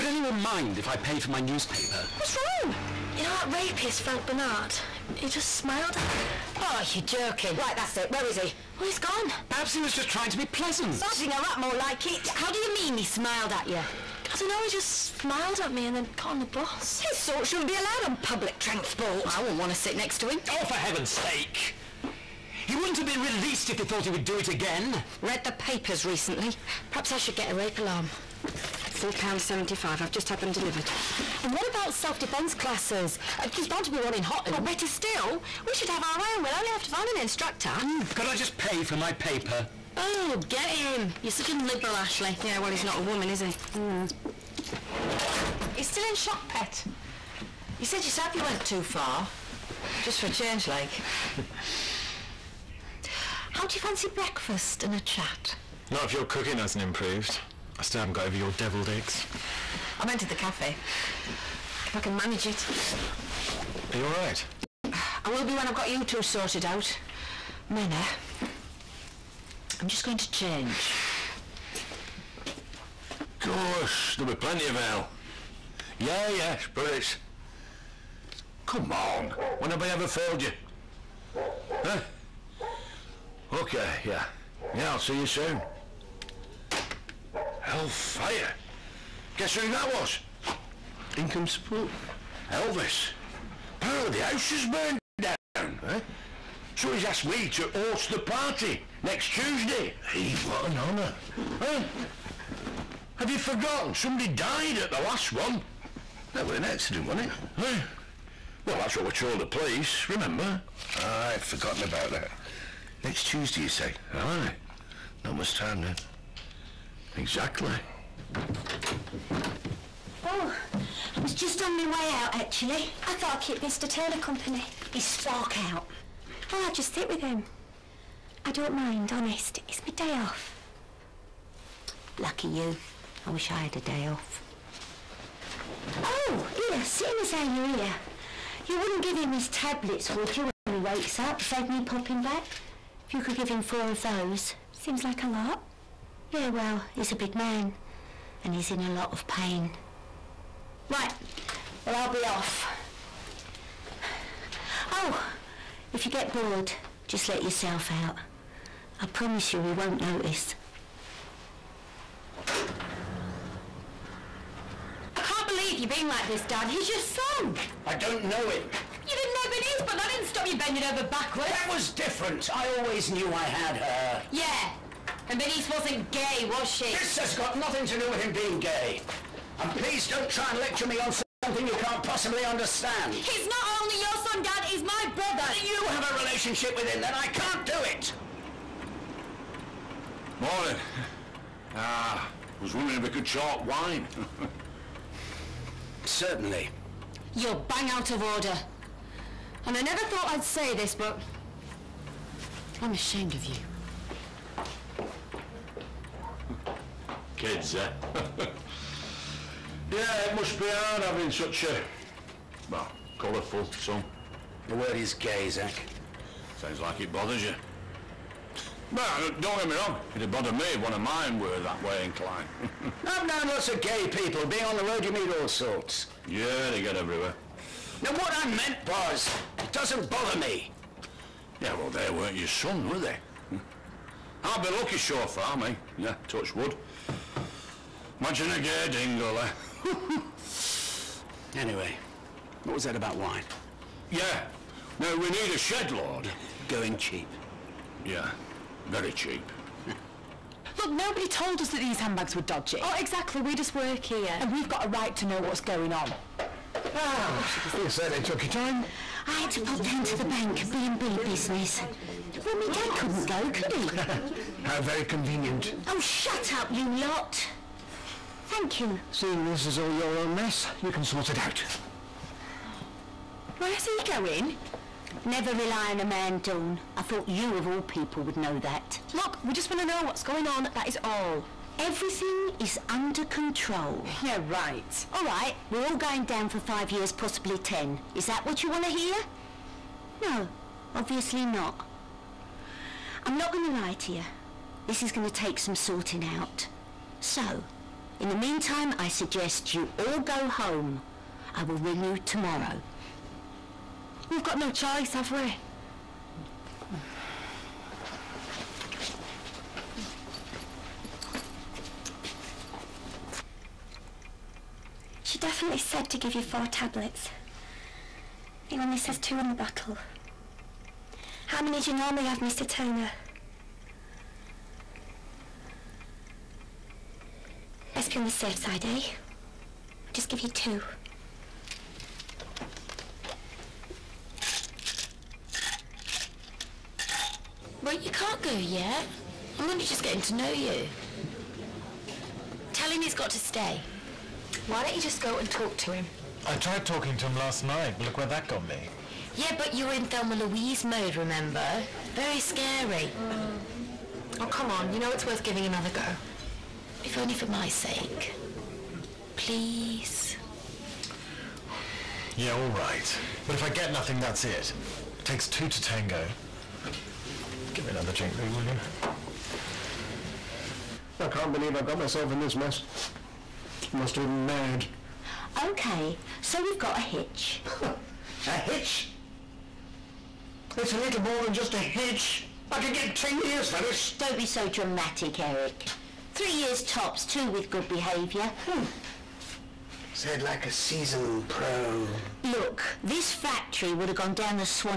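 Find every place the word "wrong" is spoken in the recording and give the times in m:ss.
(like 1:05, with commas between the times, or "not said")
0:02, 3:39.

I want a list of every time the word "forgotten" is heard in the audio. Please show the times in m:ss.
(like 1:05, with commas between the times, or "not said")
1:43, 1:51.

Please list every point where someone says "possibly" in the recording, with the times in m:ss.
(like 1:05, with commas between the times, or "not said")
3:02, 4:47.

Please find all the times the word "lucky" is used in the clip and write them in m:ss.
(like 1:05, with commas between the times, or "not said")
2:12, 3:54.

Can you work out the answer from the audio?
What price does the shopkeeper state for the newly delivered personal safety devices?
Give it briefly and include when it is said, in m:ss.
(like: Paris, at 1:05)
£4.75, at 0:28.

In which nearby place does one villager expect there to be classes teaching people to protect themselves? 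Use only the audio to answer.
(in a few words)
Hotton.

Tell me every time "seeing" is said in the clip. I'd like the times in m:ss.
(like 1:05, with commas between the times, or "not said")
2:16, 4:29.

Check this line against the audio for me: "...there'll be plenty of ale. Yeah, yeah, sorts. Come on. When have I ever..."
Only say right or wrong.
wrong.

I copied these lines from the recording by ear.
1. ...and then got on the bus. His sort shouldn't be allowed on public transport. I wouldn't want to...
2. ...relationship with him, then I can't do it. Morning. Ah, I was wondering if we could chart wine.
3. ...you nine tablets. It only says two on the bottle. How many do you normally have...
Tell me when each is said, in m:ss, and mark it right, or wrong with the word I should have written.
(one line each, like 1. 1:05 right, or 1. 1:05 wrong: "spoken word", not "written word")
1. 0:15 right
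2. 3:06 right
3. 5:16 wrong: "four", not "nine".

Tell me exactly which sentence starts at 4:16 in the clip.
Ah, you certainly took your time.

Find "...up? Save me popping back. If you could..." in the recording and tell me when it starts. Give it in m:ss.
2:21.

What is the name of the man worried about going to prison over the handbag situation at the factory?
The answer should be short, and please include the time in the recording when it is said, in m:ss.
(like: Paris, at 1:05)
Eric, at 6:25.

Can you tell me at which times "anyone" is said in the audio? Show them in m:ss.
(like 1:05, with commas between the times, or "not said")
0:00.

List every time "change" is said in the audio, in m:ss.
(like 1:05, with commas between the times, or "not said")
0:50, 1:10.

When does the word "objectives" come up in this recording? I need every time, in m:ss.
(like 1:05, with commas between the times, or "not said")
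not said.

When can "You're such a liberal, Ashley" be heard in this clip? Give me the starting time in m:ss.
0:41.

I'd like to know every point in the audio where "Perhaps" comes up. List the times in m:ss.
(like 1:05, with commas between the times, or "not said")
0:09, 0:26.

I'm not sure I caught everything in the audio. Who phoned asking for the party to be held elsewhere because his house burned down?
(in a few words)
Elvis.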